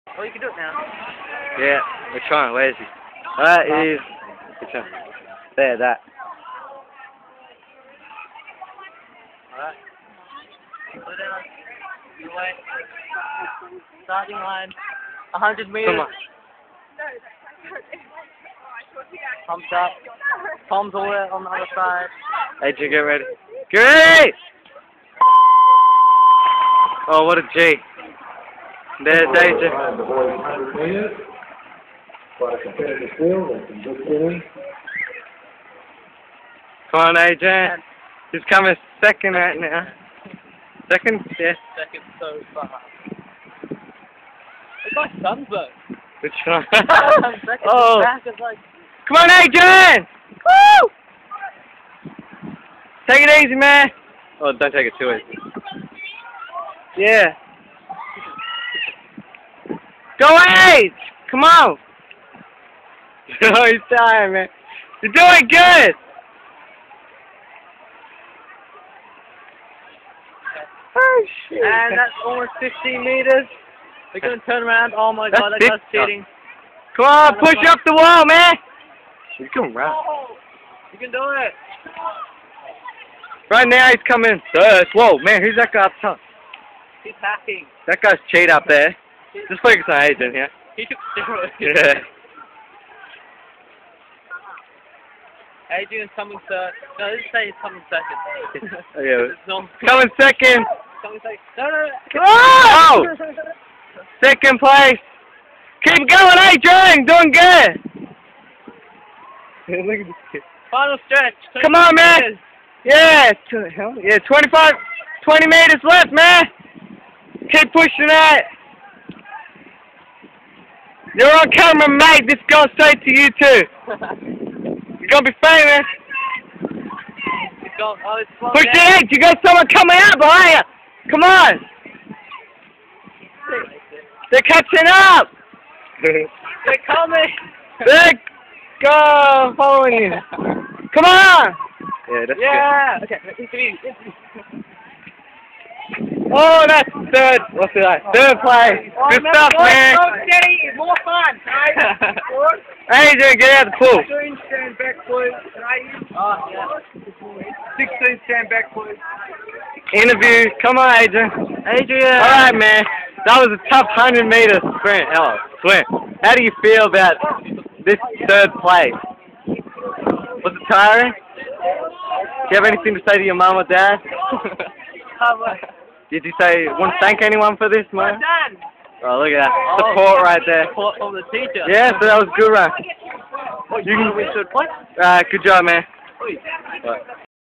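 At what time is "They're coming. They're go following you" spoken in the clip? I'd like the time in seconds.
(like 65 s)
136 s.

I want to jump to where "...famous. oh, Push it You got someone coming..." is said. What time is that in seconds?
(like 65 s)
125 s.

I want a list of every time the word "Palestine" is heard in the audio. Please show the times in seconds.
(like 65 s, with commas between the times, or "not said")
not said.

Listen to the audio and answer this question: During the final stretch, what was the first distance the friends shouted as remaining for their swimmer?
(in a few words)
25 meters.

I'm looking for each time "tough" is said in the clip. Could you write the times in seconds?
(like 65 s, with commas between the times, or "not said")
163 s.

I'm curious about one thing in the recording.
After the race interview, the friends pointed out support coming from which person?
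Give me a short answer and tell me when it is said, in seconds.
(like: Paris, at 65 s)
the teacher, at 181 s.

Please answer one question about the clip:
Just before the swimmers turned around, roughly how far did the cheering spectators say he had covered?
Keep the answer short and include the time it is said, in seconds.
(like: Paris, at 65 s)
almost 15 meters, at 72 s.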